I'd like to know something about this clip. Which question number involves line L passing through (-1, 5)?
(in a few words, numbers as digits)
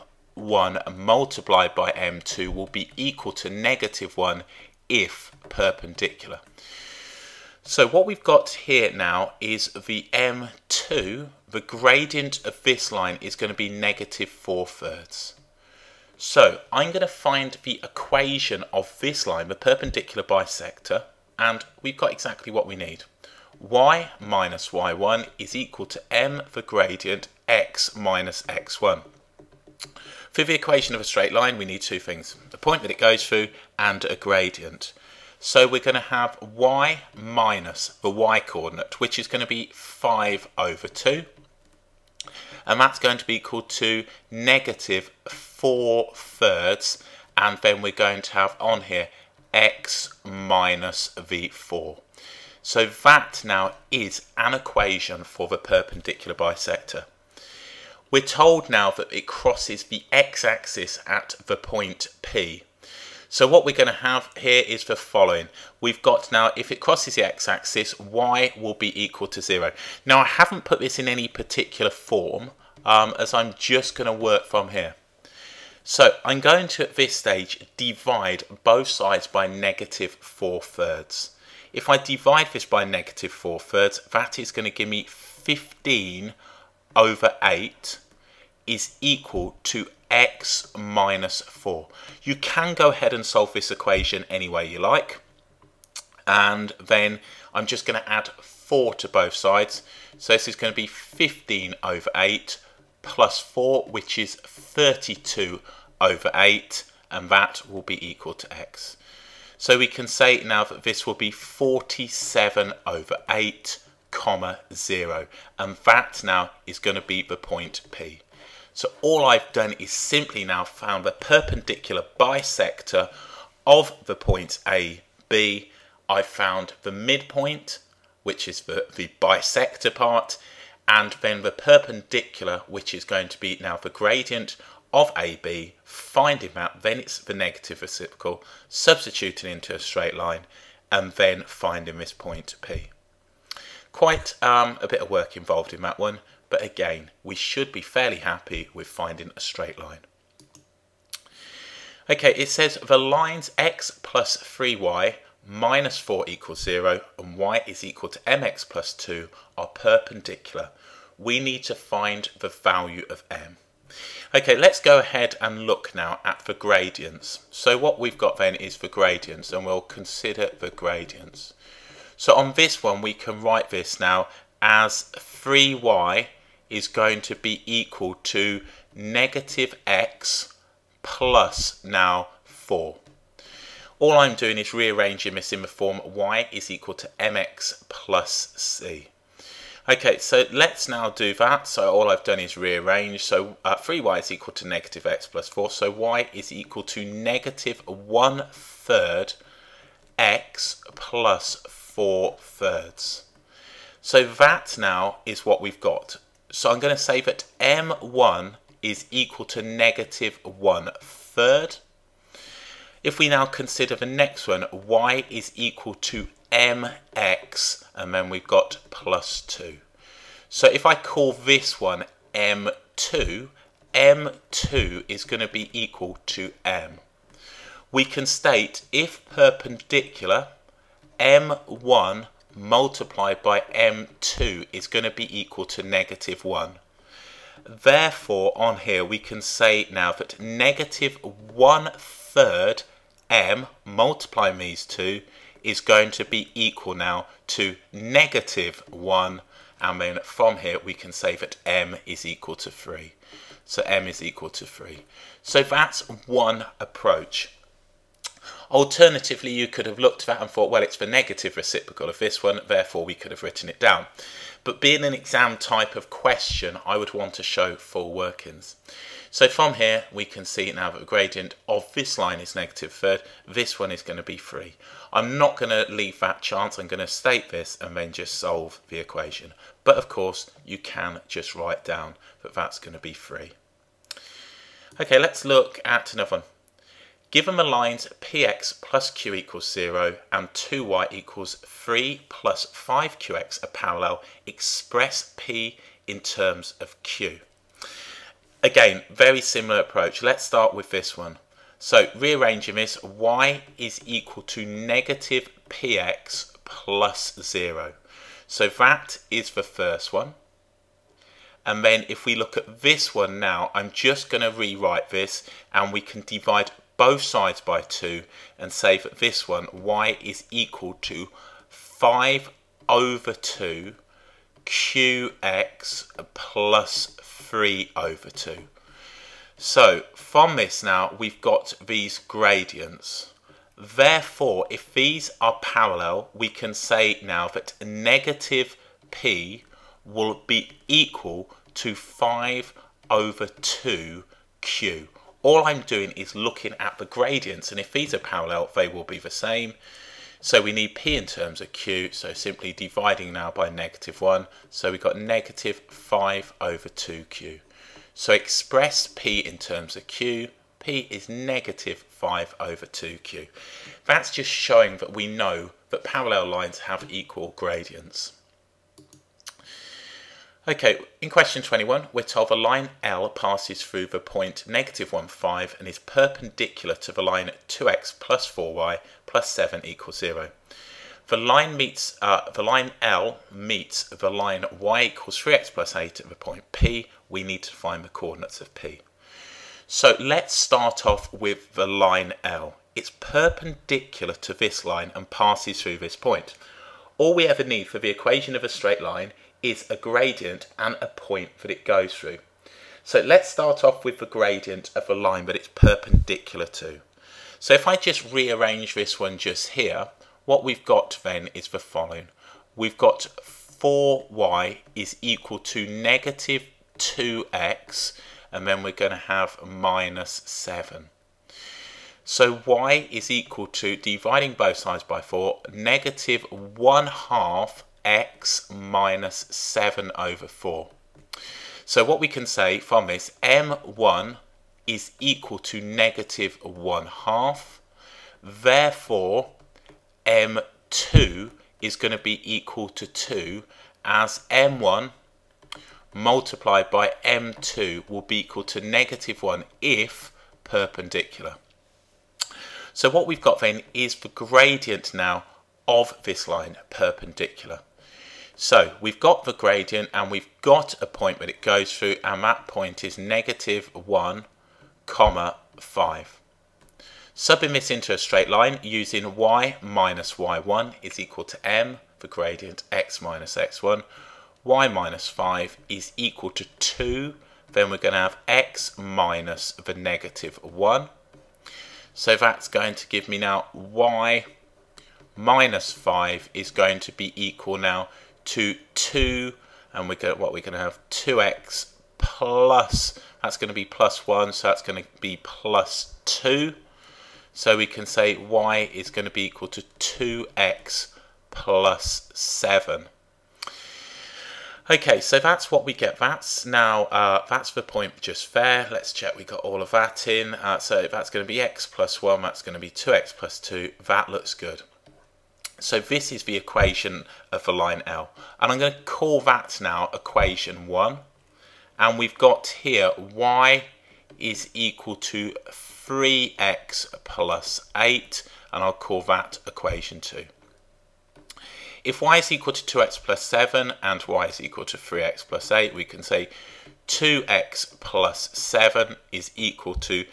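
21.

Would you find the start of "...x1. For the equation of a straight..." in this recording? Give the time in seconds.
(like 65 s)
28 s.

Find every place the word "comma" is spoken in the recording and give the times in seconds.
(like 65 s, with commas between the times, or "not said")
114 s, 465 s.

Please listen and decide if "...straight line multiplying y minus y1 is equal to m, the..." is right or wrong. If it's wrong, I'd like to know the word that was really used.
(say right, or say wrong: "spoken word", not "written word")
wrong: "using", not "multiplying".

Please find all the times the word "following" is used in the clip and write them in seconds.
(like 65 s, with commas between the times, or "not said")
64 s, 411 s.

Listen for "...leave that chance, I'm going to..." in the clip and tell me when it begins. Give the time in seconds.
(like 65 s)
275 s.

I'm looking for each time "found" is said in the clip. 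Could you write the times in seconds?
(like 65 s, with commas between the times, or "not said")
120 s, 126 s.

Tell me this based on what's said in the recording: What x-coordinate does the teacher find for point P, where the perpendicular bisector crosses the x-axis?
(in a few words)
47/8.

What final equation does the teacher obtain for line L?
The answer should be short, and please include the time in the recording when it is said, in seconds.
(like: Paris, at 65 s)
y = 2x + 7, at 498 s.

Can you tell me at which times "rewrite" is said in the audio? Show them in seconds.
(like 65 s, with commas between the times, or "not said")
314 s.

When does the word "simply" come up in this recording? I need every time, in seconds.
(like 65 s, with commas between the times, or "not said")
119 s, 352 s.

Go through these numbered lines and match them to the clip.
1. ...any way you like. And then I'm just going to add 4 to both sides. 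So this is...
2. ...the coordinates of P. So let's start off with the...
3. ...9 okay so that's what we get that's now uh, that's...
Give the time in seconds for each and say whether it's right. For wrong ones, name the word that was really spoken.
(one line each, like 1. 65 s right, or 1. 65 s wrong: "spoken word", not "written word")
1. 94 s right
2. 388 s right
3. 502 s wrong: "7", not "9".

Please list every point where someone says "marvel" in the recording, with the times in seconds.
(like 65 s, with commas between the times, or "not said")
not said.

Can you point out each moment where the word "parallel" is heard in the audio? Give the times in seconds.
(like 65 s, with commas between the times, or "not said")
293 s, 335 s, 348 s, 366 s.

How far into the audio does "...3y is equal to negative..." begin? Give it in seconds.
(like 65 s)
193 s.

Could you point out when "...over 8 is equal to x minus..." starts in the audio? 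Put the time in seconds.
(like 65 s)
86 s.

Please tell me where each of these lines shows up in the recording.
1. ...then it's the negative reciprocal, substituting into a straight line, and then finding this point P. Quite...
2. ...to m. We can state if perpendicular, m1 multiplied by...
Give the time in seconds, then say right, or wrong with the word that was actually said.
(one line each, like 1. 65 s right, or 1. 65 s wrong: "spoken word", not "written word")
1. 136 s right
2. 226 s right.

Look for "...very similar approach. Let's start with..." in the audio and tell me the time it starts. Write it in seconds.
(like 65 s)
299 s.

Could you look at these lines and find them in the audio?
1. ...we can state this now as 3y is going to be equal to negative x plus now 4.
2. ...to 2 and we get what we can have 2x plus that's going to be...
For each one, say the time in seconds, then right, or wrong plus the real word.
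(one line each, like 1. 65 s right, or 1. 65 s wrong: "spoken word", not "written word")
1. 173 s wrong: "write", not "state"
2. 488 s right.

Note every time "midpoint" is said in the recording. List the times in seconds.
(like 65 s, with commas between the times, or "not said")
126 s.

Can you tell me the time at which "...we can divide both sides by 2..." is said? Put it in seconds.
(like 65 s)
315 s.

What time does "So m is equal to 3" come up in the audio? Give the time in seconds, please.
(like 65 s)
253 s.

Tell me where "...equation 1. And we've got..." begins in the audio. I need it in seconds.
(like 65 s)
520 s.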